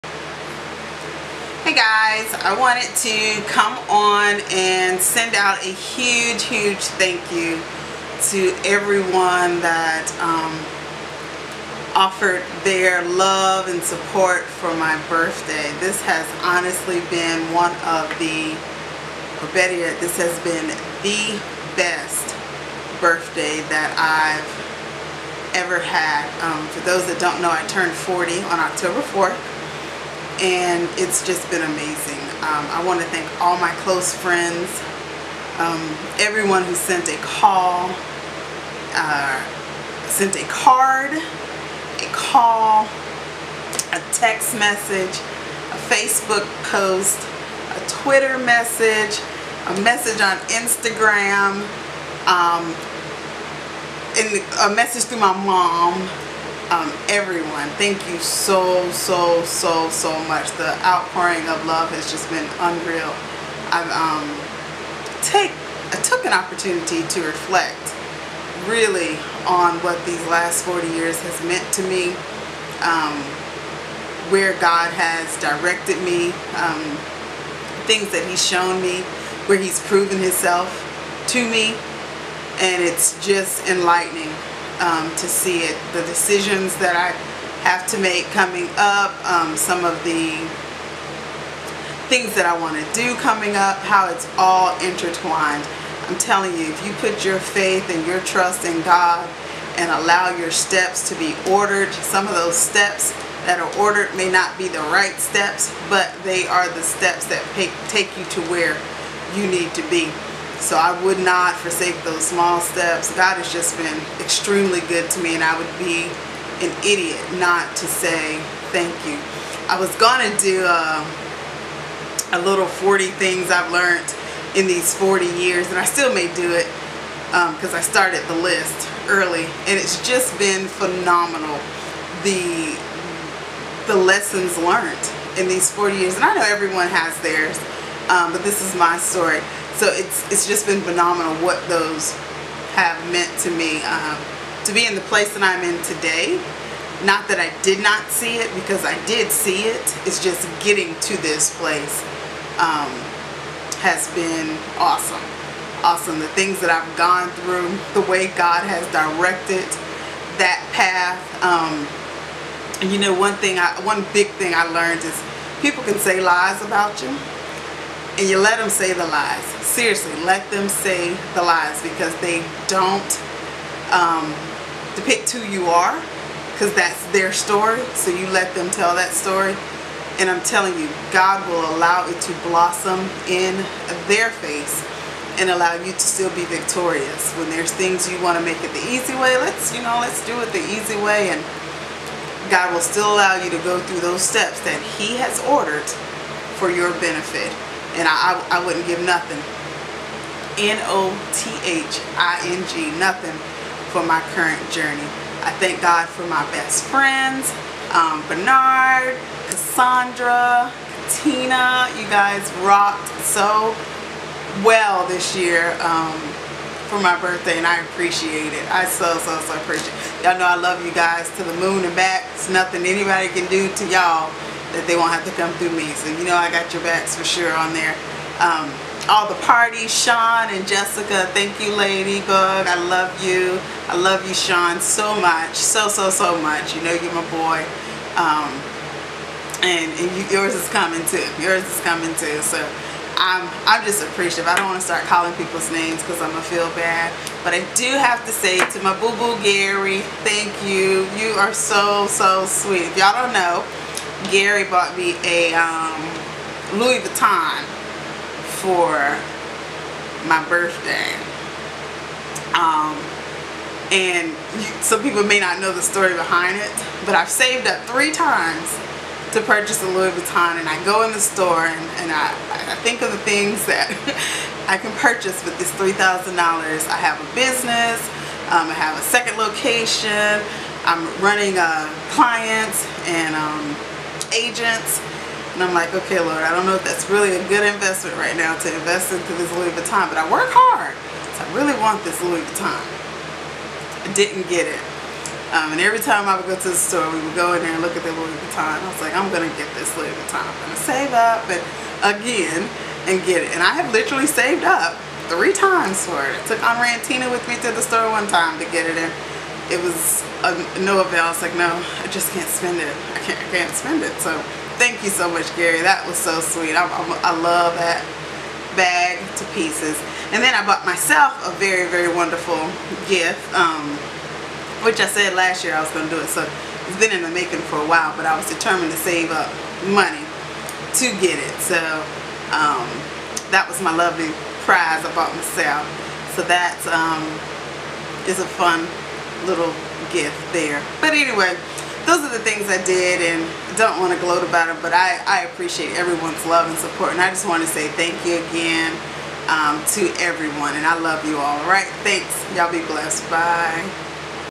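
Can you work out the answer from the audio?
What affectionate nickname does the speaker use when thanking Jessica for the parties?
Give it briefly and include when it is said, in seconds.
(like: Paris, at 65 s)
Ladybug, at 231 s.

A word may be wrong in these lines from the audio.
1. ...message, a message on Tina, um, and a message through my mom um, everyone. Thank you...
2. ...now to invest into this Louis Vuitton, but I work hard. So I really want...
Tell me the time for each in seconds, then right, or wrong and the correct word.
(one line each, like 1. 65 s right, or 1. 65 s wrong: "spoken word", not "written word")
1. 48 s wrong: "Instagram", not "Tina"
2. 288 s right.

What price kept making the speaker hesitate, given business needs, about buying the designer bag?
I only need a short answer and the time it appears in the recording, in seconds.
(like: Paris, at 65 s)
$3,000, at 275 s.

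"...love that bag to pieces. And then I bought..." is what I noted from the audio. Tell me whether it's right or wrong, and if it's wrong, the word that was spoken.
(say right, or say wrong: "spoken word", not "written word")
right.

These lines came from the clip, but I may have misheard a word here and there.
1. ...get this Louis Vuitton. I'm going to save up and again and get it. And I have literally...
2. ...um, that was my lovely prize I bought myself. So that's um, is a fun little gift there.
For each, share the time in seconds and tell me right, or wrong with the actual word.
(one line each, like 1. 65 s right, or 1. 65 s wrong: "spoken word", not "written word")
1. 299 s right
2. 332 s right.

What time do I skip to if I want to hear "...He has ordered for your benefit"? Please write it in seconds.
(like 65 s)
194 s.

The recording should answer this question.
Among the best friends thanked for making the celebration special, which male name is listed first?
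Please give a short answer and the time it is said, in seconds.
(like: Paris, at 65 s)
Bernard, at 208 s.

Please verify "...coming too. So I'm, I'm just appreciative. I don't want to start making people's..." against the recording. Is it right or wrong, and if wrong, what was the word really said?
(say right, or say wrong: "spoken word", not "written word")
wrong: "calling", not "making".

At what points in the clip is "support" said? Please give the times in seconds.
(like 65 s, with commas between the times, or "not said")
13 s, 346 s.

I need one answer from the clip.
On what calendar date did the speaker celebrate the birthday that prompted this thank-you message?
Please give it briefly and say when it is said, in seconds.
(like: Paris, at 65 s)
October 4, at 28 s.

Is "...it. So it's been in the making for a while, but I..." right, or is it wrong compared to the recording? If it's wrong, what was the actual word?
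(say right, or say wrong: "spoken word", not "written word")
right.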